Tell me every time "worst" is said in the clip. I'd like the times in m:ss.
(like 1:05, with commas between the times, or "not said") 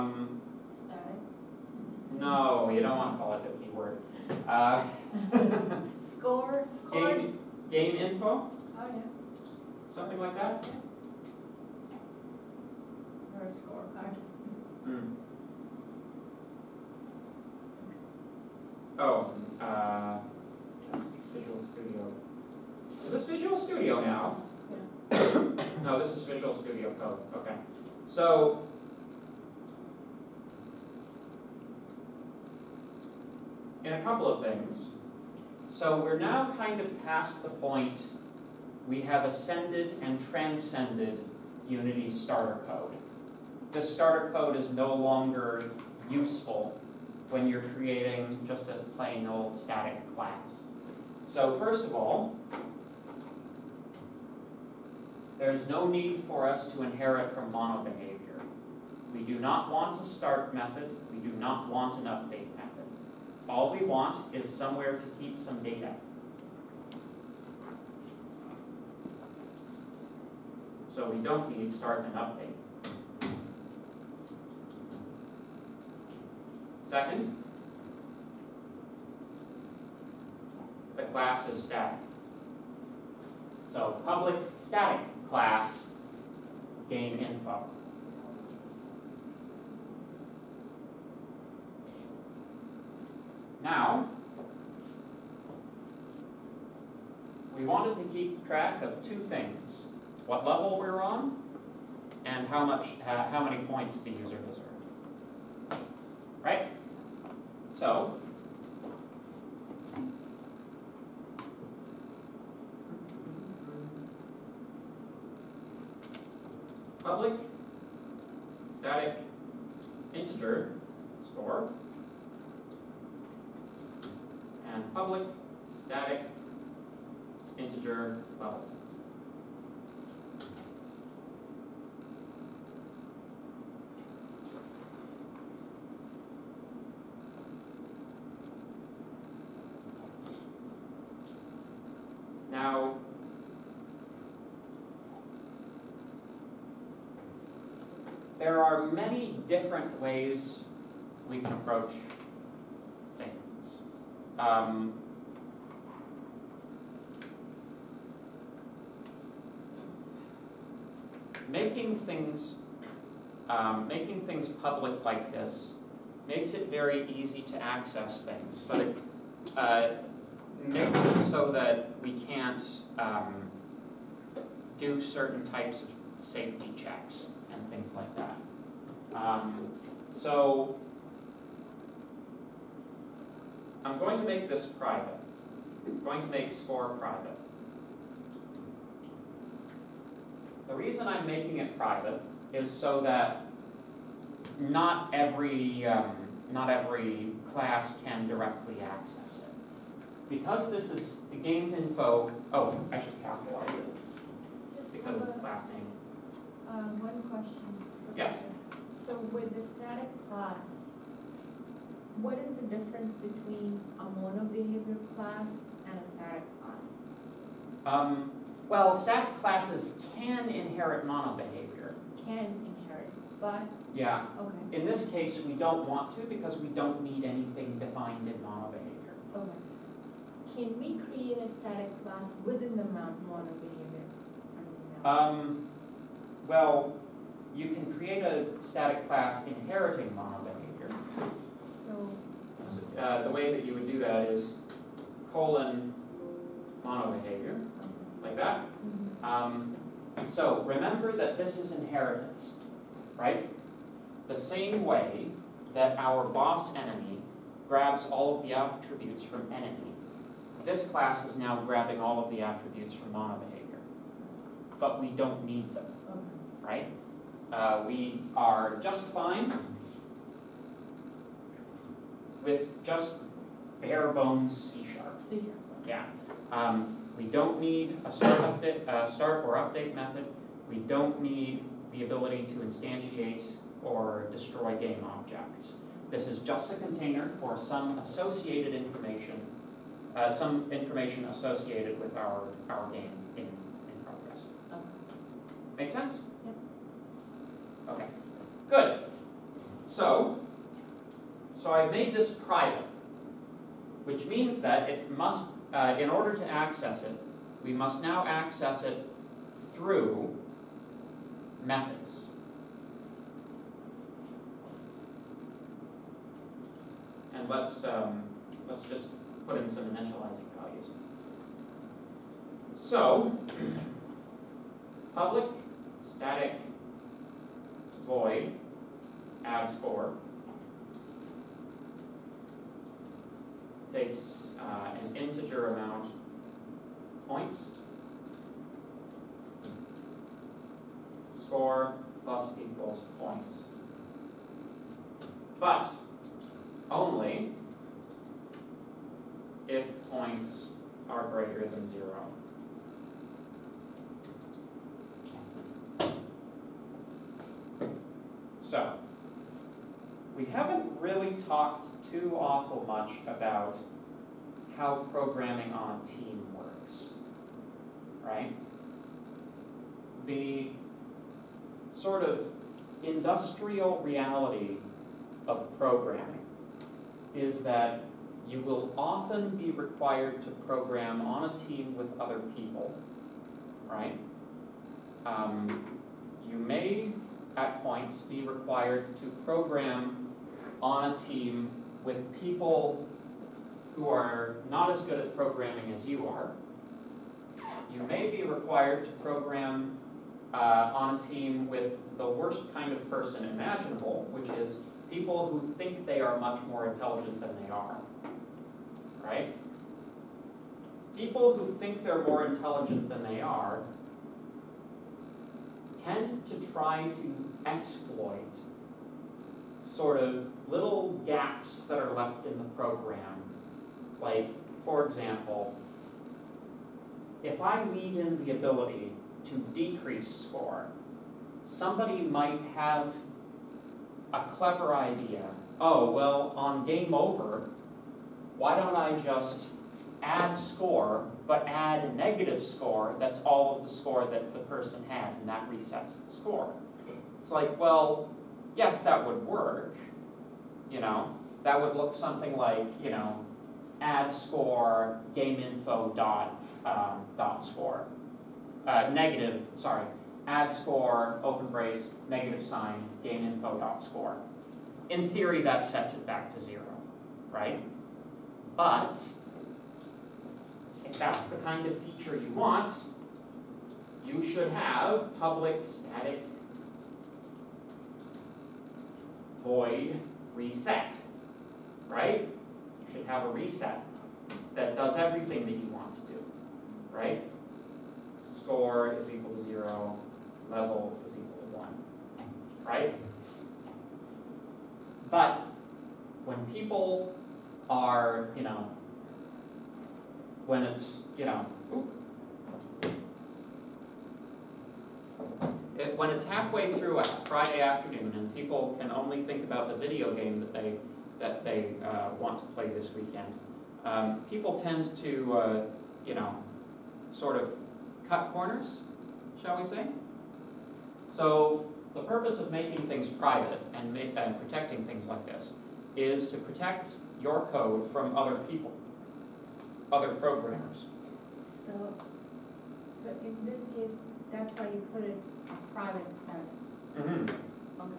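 6:42.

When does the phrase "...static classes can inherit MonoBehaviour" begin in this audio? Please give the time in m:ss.
3:38.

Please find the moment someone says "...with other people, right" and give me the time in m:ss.
6:21.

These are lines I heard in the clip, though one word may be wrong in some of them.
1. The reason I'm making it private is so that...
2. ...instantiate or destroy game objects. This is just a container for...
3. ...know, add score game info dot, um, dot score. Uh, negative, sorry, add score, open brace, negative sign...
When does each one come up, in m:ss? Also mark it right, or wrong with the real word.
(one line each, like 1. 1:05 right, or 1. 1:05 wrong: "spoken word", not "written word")
1. 3:10 right
2. 4:42 right
3. 7:33 right.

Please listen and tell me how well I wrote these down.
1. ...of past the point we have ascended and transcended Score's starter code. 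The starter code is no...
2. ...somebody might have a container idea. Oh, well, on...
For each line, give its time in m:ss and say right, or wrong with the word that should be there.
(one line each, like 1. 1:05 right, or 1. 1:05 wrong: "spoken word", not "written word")
1. 0:36 wrong: "Unity", not "Score"
2. 7:11 wrong: "clever", not "container".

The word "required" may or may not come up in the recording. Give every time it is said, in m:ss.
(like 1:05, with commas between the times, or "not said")
6:19, 6:28, 6:38.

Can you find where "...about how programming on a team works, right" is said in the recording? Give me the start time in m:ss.
6:03.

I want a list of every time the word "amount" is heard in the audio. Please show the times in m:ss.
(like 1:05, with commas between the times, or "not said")
5:35.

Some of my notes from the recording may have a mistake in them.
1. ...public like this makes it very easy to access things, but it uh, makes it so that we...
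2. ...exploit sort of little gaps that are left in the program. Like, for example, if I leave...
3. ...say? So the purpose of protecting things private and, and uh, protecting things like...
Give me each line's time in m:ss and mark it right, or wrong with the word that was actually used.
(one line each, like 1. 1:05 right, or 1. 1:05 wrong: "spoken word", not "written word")
1. 2:44 right
2. 6:57 right
3. 8:39 wrong: "making", not "protecting".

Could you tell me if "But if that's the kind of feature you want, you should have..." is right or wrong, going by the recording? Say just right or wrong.
right.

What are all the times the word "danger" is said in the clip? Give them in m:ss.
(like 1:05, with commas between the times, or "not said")
not said.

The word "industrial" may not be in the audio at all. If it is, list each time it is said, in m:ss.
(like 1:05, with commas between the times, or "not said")
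6:13.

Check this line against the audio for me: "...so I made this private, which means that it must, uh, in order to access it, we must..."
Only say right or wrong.
right.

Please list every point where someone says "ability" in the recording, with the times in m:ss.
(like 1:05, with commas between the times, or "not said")
4:42, 7:08.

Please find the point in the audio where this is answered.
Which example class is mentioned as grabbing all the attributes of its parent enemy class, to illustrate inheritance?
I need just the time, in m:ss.
4:16.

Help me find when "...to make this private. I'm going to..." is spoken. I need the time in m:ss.
3:04.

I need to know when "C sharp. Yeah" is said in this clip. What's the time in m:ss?
4:35.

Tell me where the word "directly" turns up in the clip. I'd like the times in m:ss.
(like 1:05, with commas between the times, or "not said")
3:18.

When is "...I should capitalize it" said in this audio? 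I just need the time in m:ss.
3:22.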